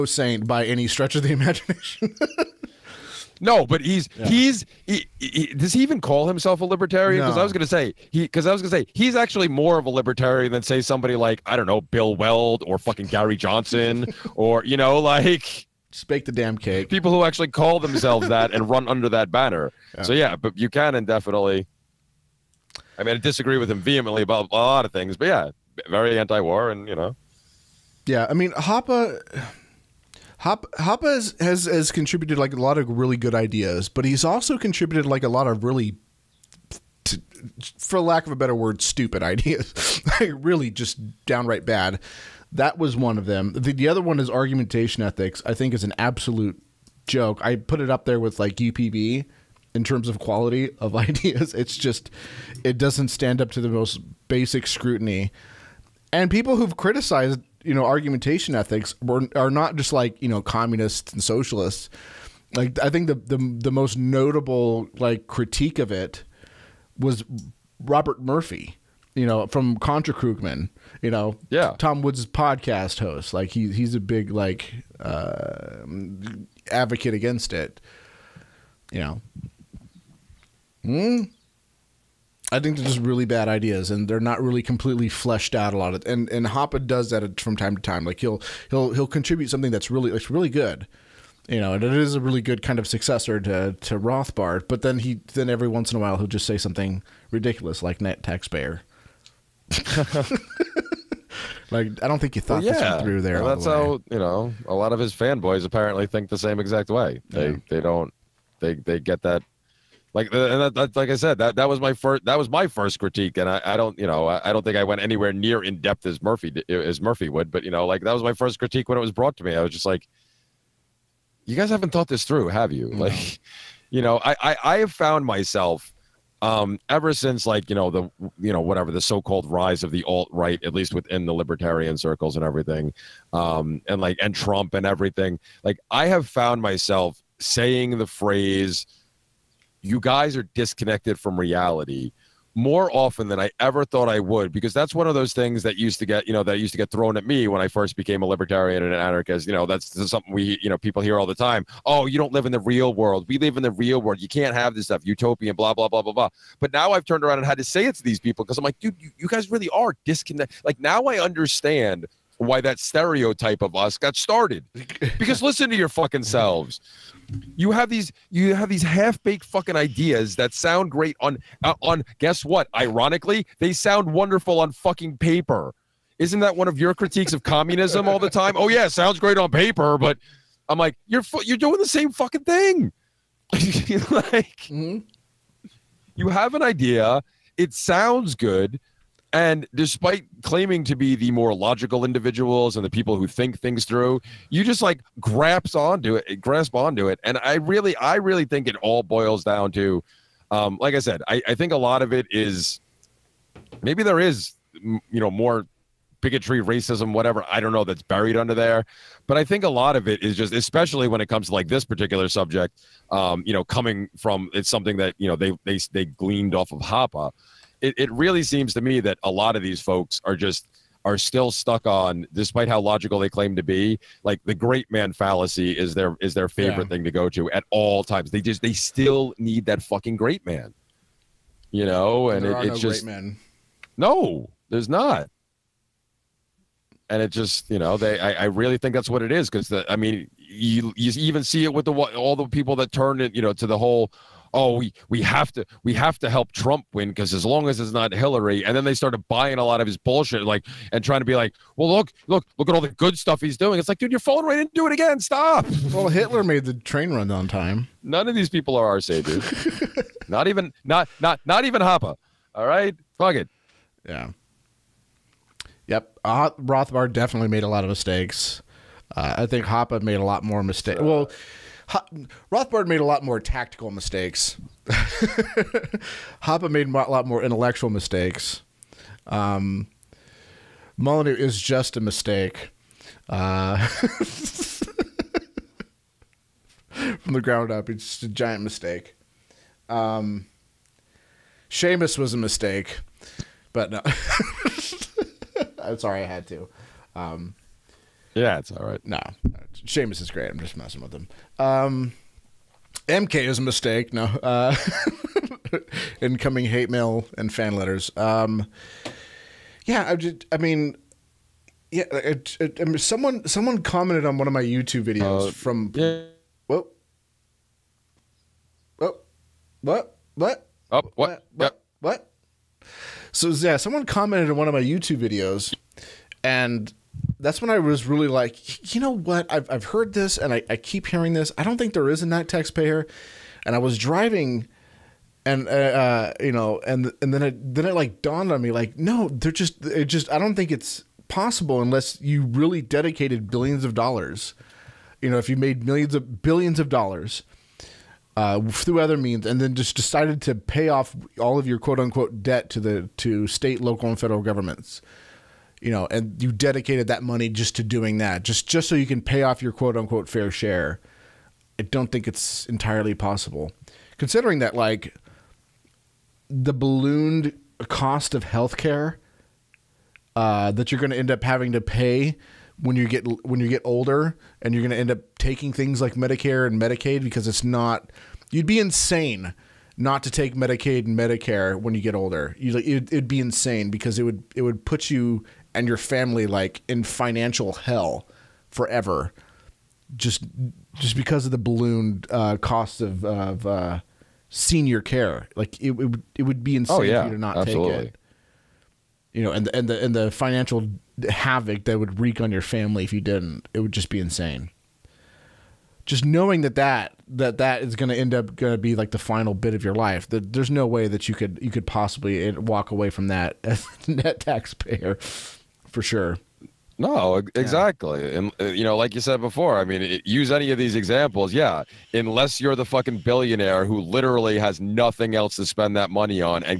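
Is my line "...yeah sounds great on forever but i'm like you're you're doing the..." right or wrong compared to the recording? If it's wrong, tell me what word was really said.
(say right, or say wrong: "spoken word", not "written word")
wrong: "paper", not "forever".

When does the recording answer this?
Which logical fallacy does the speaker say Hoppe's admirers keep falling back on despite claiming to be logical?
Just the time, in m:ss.
3:44.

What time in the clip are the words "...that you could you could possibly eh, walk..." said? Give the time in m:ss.
6:51.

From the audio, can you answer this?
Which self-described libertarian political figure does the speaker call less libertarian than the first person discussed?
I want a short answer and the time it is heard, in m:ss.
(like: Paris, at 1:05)
Bill Weld, at 0:11.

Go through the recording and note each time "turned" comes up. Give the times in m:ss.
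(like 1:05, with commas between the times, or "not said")
2:37, 4:02.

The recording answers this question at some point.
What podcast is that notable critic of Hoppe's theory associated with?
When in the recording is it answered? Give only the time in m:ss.
1:09.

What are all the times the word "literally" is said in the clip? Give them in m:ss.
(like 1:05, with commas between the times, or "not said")
7:03.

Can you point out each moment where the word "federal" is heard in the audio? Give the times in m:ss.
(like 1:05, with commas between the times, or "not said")
5:54.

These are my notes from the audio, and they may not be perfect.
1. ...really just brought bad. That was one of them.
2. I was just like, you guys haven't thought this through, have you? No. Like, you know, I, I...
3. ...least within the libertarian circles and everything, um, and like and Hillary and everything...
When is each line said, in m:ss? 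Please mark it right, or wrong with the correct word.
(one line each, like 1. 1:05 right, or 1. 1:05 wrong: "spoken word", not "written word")
1. 0:40 wrong: "downright", not "brought"
2. 1:59 right
3. 2:10 wrong: "Trump", not "Hillary".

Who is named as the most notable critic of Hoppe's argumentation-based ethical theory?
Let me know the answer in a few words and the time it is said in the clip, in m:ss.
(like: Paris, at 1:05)
Robert Murphy, at 1:07.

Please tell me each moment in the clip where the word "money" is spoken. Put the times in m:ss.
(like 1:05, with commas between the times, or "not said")
5:57, 7:06.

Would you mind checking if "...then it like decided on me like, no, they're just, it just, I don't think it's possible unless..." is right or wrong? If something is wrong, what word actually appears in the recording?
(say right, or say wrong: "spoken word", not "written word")
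wrong: "dawned", not "decided".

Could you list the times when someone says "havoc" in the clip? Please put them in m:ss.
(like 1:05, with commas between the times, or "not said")
6:41.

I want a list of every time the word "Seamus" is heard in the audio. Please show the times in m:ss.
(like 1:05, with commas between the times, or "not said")
4:51, 4:59.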